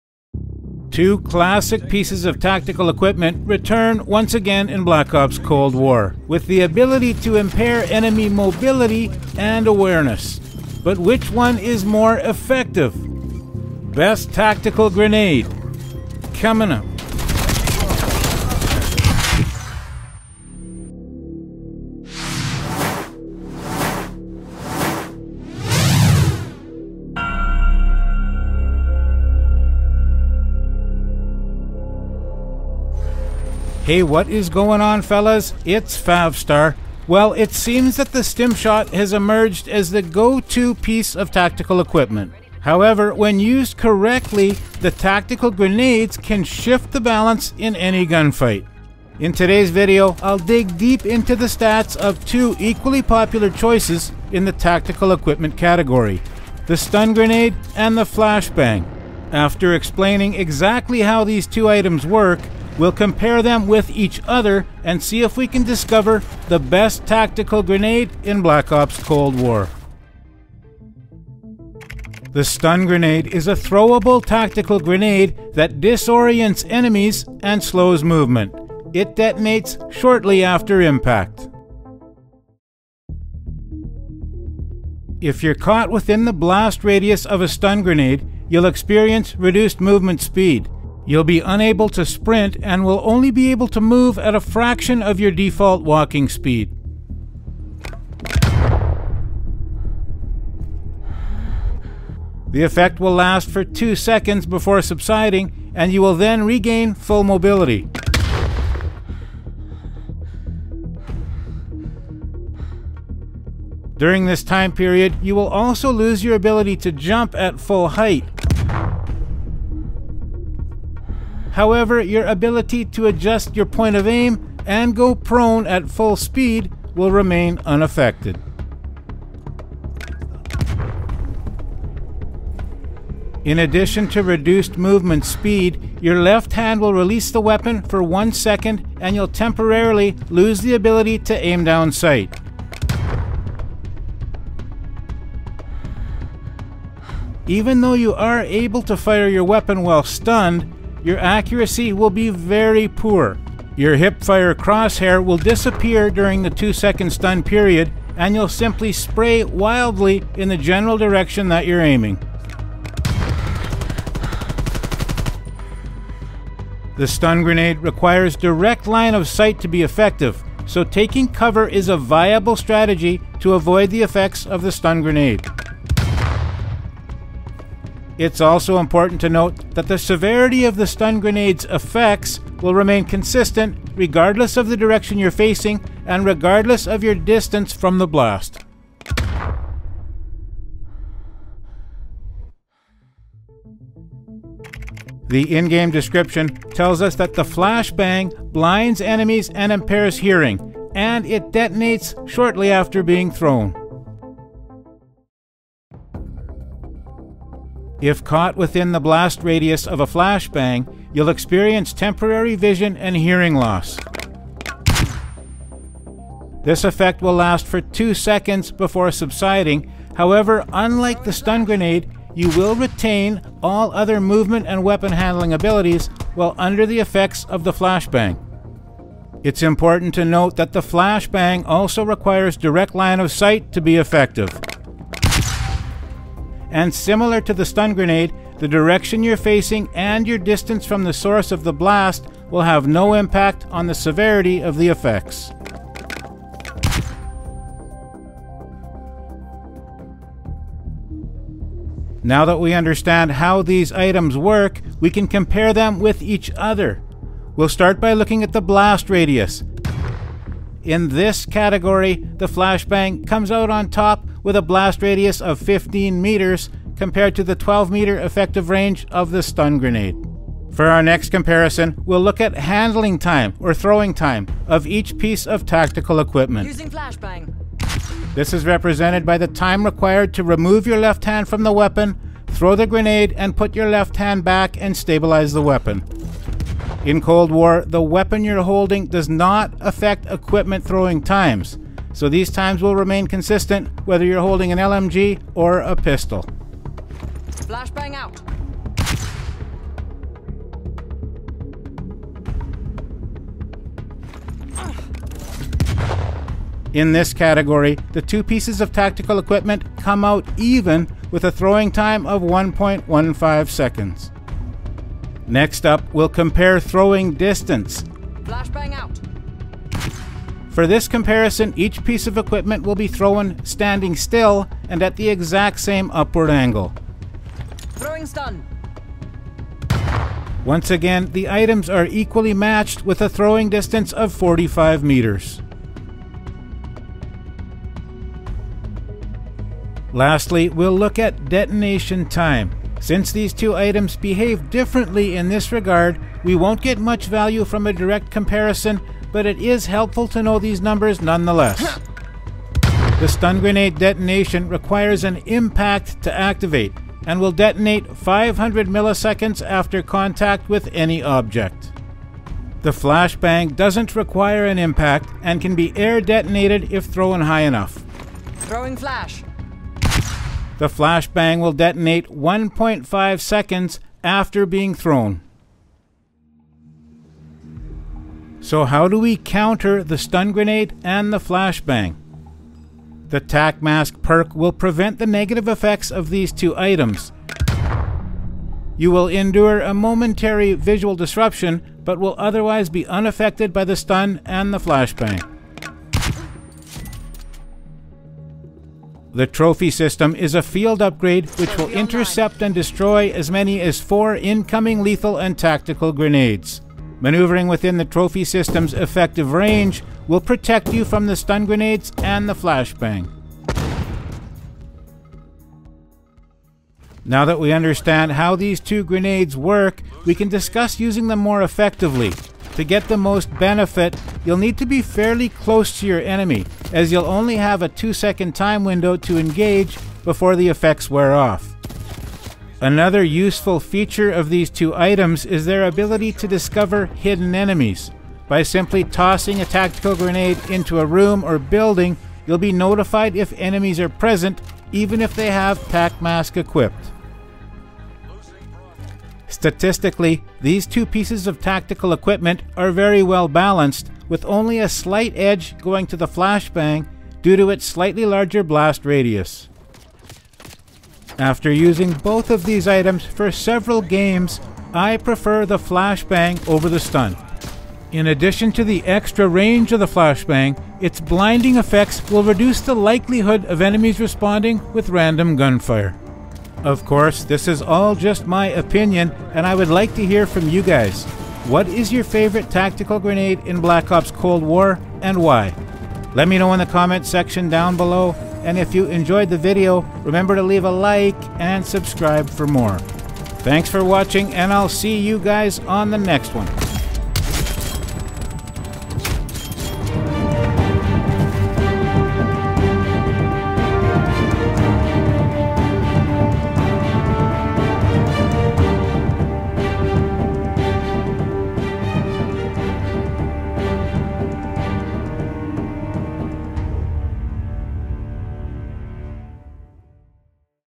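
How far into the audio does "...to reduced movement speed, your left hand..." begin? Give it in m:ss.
2:14.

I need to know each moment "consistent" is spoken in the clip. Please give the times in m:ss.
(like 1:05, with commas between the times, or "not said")
3:03, 4:53.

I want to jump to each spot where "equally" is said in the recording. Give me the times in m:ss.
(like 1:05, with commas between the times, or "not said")
0:52, 5:32.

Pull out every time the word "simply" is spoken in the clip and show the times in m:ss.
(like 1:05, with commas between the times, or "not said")
2:38, 7:18.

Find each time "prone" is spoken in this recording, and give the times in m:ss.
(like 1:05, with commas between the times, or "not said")
2:05.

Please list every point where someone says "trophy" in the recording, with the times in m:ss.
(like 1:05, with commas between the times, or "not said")
6:39, 6:48.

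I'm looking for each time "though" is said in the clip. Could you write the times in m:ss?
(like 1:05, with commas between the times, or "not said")
2:27.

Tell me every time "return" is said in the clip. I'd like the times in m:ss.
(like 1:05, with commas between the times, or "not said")
0:03.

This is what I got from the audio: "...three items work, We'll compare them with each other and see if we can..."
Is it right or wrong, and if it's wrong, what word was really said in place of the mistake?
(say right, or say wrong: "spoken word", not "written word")
wrong: "two", not "three".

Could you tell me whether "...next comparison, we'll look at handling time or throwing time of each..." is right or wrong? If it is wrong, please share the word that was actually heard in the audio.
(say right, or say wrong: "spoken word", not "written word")
right.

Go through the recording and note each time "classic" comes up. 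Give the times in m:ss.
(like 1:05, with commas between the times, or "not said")
0:01.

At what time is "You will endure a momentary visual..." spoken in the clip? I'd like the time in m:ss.
6:28.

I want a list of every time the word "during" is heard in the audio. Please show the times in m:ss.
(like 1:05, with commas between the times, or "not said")
1:53, 2:36.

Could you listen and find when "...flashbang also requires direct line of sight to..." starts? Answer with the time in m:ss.
3:50.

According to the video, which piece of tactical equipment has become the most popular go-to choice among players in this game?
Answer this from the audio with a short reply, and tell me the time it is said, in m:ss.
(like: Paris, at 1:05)
Stimshot, at 0:38.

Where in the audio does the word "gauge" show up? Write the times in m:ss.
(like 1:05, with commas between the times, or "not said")
not said.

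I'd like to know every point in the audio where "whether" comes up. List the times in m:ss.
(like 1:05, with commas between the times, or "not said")
4:54.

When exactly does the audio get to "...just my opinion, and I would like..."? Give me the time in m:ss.
7:58.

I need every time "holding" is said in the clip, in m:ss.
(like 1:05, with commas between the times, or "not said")
4:48, 4:54.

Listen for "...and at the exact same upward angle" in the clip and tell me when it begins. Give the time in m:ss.
5:24.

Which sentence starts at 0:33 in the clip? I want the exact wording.
Hey, what is going on, fellas?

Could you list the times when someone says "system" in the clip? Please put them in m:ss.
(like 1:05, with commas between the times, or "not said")
6:39, 6:48.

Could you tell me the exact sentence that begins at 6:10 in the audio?
The flashbang will detonate 1.5 seconds after being thrown.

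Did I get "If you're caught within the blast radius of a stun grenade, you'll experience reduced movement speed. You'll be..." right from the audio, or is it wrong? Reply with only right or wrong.
right.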